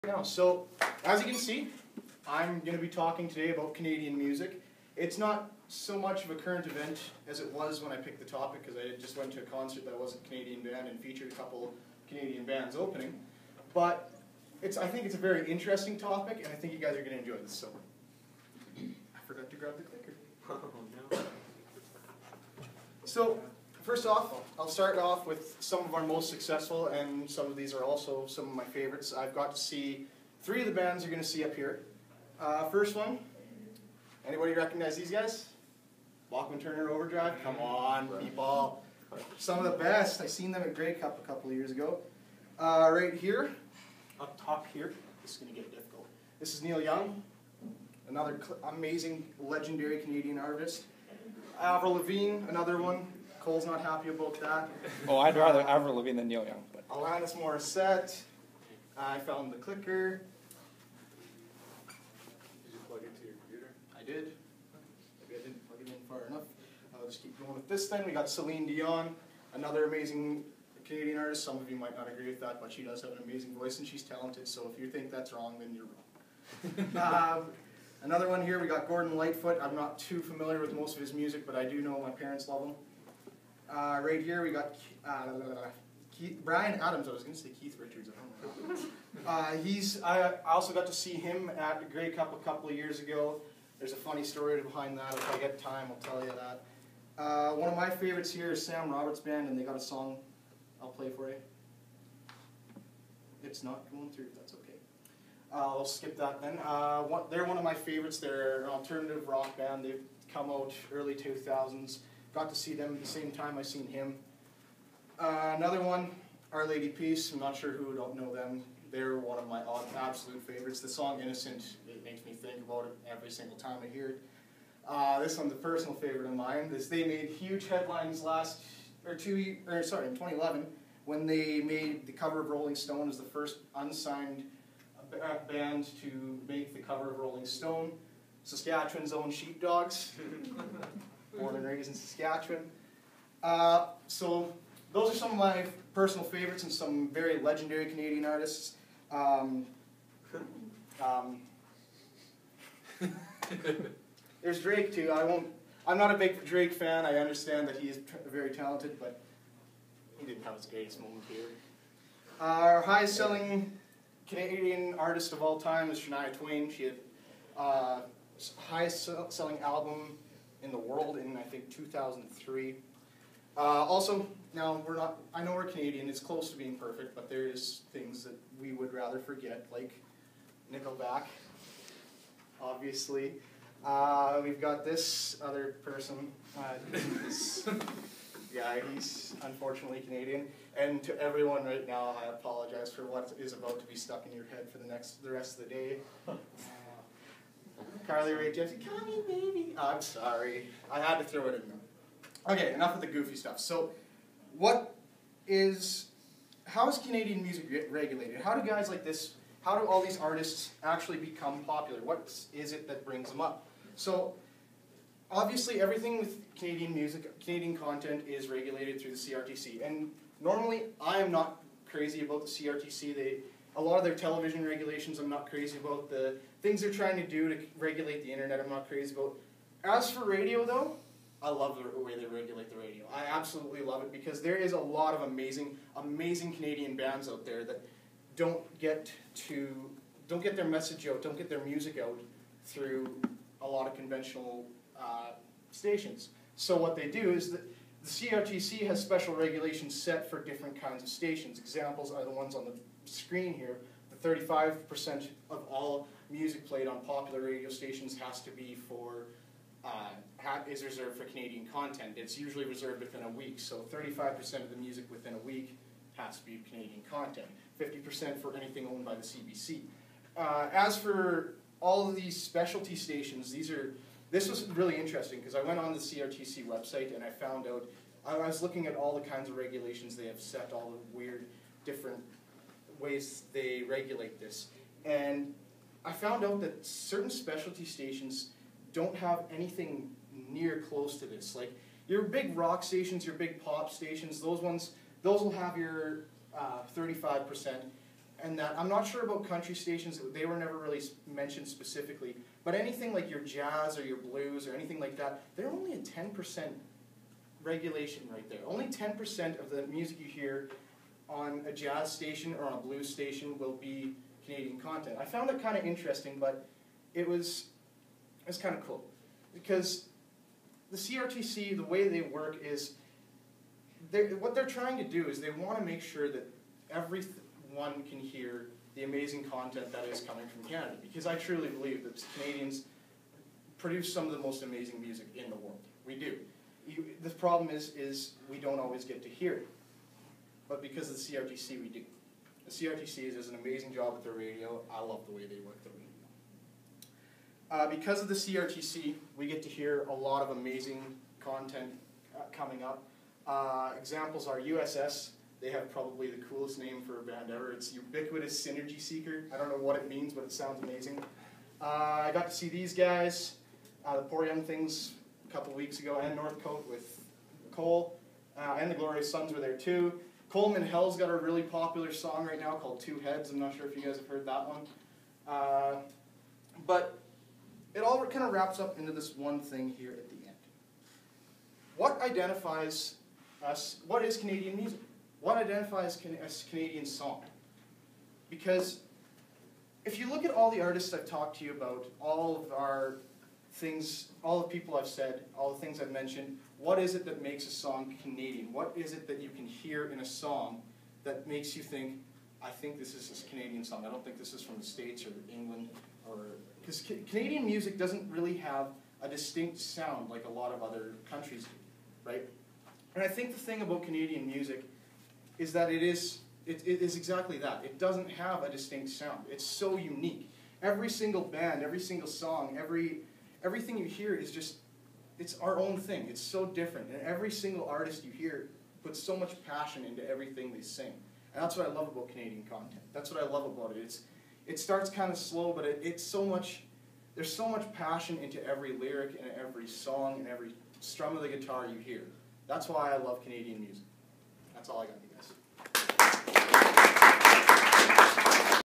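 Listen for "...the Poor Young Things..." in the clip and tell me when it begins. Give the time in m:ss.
6:04.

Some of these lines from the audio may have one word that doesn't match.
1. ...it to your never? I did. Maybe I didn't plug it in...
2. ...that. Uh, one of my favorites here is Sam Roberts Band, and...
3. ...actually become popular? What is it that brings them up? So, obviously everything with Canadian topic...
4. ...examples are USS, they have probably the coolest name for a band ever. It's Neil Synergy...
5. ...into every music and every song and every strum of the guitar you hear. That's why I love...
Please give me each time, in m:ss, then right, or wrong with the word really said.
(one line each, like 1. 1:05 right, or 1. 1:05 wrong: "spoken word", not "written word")
1. 1:03 wrong: "computer", not "never"
2. 1:36 right
3. 3:30 wrong: "music", not "topic"
4. 5:53 wrong: "Ubiquitous", not "Neil"
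5. 7:18 wrong: "lyric", not "music".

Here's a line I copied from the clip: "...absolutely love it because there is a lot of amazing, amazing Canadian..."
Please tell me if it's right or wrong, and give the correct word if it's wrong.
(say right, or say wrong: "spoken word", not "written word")
right.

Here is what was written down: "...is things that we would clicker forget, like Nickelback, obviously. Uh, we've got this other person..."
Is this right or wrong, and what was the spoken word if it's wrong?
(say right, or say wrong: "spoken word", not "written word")
wrong: "rather", not "clicker".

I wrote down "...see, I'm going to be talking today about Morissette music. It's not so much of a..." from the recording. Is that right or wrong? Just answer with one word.
wrong.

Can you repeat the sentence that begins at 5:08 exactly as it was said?
Only 10% of the music you hear on a jazz station or on a blues station will be Canadian content.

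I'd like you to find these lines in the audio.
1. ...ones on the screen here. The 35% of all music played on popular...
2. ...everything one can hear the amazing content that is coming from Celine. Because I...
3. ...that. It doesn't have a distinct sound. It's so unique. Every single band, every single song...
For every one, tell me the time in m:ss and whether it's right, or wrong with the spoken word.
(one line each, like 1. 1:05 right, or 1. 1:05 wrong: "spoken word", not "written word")
1. 4:12 right
2. 5:26 wrong: "Canada", not "Celine"
3. 6:57 right.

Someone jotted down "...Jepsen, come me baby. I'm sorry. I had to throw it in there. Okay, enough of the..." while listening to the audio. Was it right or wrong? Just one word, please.
right.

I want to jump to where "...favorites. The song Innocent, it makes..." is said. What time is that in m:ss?
2:00.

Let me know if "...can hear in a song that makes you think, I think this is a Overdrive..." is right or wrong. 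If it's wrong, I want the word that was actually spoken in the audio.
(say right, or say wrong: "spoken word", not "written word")
wrong: "Canadian", not "Overdrive".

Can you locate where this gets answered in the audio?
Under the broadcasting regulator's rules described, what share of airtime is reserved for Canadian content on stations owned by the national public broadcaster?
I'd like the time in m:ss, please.
4:27.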